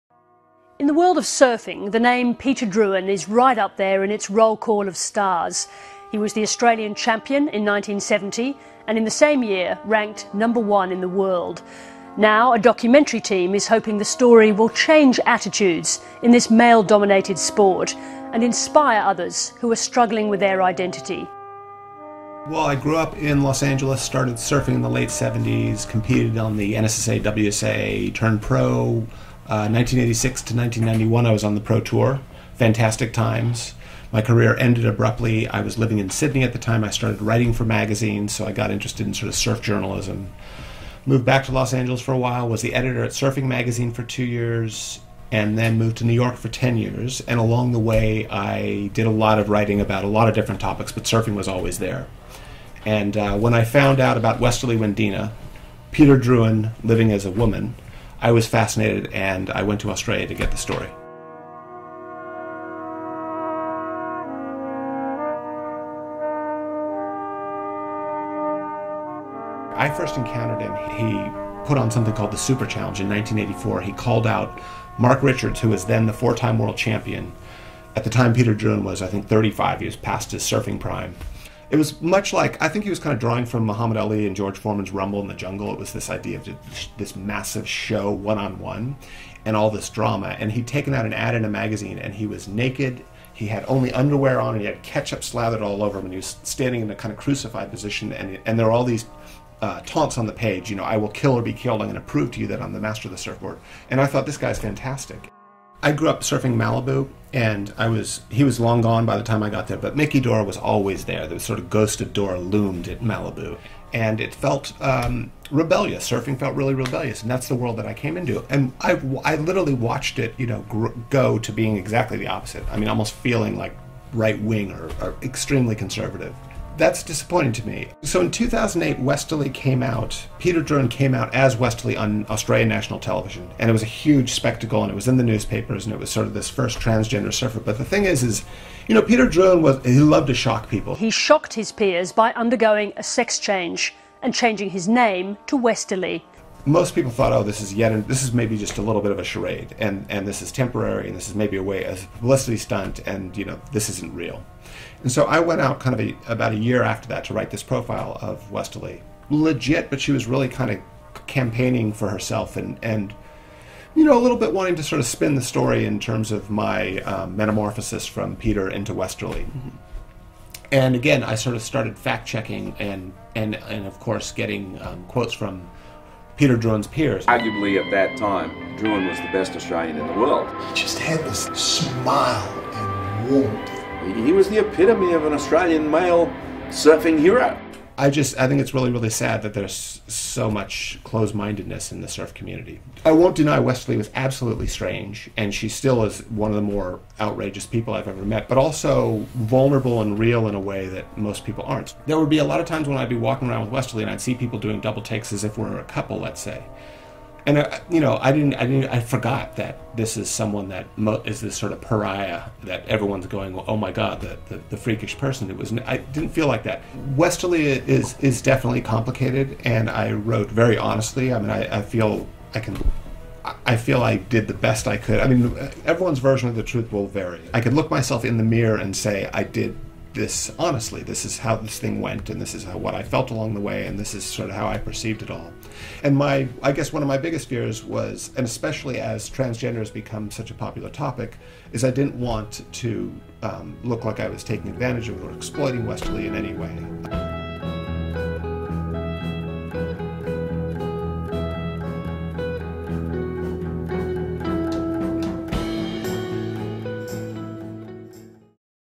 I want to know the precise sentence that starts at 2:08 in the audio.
So in 2008, Westerly came out, Peter Drouyn came out as Westerly on Australian national television.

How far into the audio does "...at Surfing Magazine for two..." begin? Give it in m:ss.
0:43.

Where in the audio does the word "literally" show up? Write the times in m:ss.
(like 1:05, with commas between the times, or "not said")
1:59.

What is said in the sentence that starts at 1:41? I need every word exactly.
I'm going to prove to you that I'm the master of the surfboard.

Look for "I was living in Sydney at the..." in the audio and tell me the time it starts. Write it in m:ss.
0:35.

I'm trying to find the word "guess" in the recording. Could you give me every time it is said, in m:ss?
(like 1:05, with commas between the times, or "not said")
3:56.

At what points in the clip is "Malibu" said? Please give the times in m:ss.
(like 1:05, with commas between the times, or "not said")
1:46, 1:53.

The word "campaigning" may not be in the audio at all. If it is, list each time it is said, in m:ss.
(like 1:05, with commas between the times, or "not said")
2:41.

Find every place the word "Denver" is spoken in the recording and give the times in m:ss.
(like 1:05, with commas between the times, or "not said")
not said.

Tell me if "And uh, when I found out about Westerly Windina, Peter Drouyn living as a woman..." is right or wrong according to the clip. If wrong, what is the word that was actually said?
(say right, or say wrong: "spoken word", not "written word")
right.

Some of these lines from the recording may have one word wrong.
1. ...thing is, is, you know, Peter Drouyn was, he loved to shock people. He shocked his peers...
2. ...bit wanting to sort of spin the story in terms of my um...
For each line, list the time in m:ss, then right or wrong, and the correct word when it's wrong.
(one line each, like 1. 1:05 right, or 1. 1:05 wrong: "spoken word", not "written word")
1. 2:17 right
2. 2:44 right.